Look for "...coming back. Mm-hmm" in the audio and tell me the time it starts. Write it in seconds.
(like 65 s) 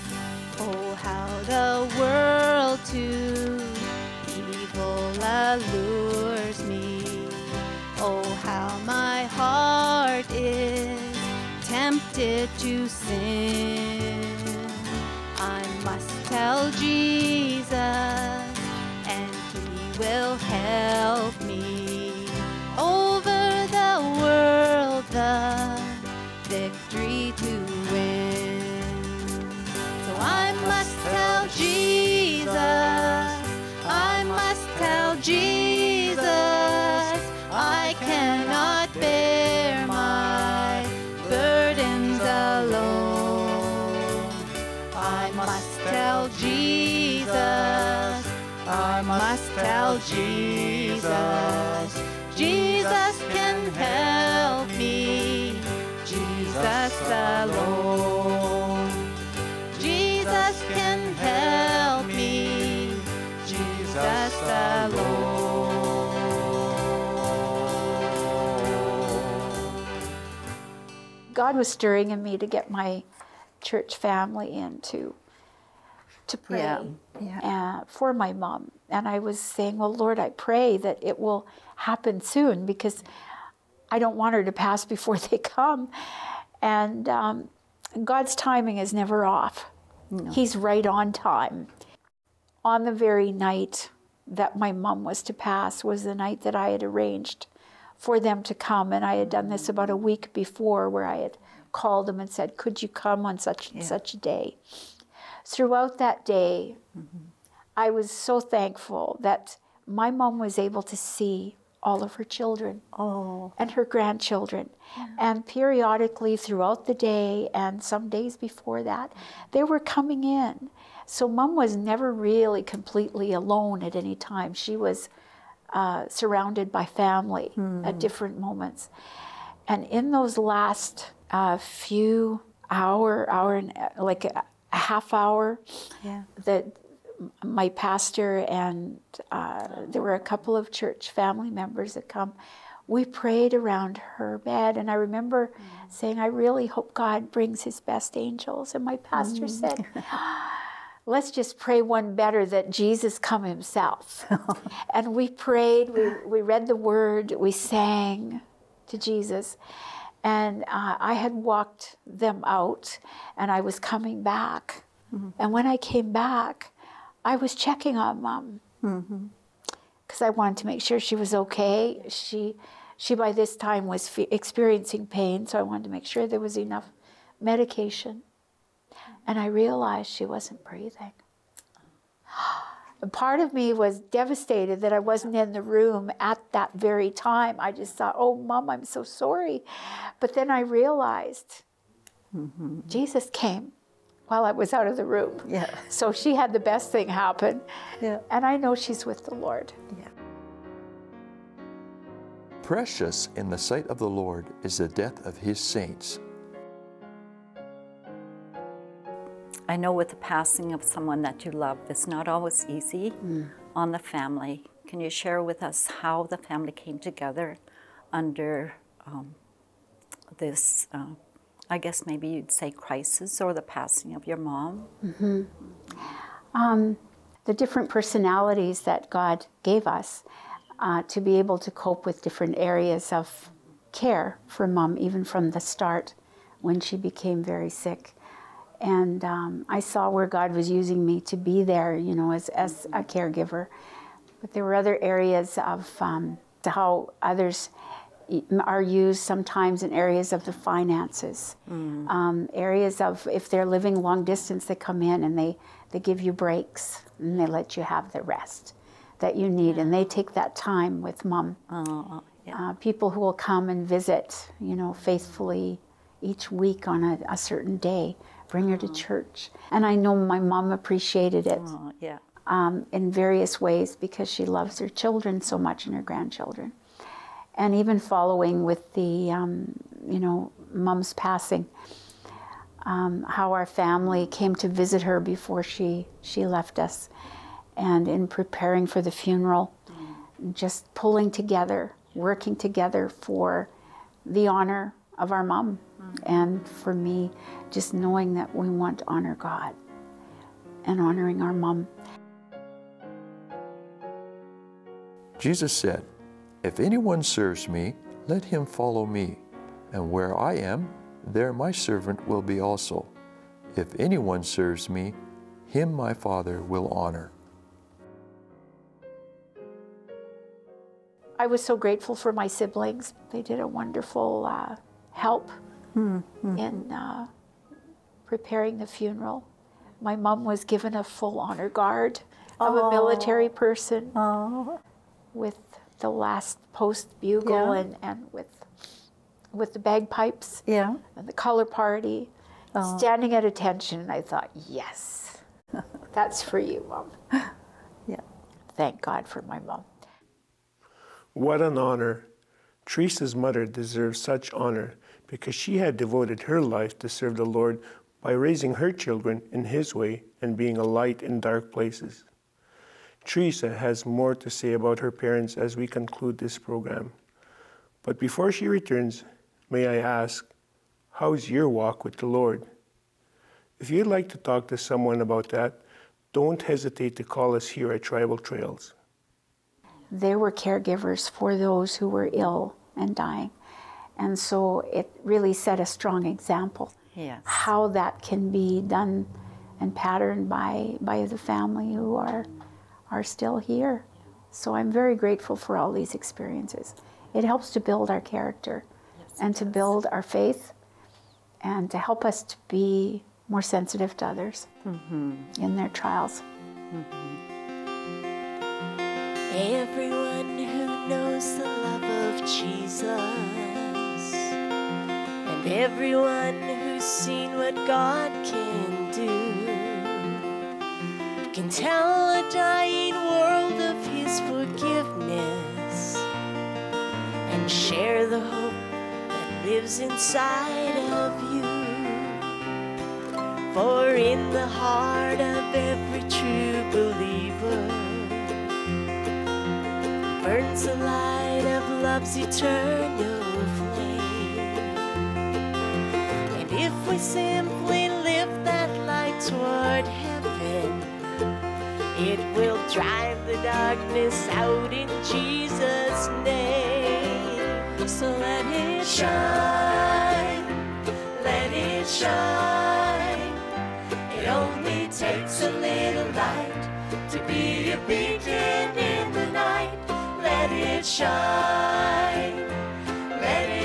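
163 s.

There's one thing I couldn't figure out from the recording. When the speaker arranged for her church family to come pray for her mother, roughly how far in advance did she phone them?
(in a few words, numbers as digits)
About a week before.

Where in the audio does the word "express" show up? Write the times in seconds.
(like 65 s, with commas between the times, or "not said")
not said.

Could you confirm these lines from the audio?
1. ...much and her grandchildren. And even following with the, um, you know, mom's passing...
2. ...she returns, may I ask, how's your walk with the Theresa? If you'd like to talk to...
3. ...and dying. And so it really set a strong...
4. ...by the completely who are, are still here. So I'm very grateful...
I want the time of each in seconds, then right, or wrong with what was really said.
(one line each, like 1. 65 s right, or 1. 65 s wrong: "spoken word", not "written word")
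1. 275 s right
2. 368 s wrong: "Lord", not "Theresa"
3. 382 s right
4. 390 s wrong: "family", not "completely".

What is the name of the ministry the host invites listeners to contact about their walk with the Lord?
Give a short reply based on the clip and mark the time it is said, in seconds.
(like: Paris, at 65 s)
Tribal Trails, at 378 s.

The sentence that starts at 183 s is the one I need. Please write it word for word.
And part of me was devastated that I wasn't in the room at that very time.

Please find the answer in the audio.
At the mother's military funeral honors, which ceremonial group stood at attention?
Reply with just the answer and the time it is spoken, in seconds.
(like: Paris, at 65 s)
The color party, at 341 s.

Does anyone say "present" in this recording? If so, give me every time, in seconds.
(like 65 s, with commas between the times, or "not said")
not said.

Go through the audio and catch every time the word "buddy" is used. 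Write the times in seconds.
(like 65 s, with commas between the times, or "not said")
not said.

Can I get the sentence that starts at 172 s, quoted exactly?
She, she by this time was fe- experiencing pain, so I wanted to make sure there was enough medication.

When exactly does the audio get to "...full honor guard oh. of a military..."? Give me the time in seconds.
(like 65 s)
331 s.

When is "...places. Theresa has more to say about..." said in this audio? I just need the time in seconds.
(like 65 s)
361 s.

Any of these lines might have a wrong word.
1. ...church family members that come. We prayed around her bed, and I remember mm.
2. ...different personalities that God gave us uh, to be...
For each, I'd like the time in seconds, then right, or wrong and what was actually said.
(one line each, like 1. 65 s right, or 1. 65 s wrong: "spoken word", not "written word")
1. 140 s right
2. 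227 s right.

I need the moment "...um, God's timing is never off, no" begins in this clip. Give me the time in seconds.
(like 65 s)
87 s.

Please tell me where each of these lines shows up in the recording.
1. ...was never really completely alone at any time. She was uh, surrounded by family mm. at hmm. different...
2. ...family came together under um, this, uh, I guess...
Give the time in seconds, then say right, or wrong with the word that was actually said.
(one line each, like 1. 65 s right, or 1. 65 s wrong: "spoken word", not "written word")
1. 121 s right
2. 216 s right.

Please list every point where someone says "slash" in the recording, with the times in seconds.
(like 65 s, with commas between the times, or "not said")
not said.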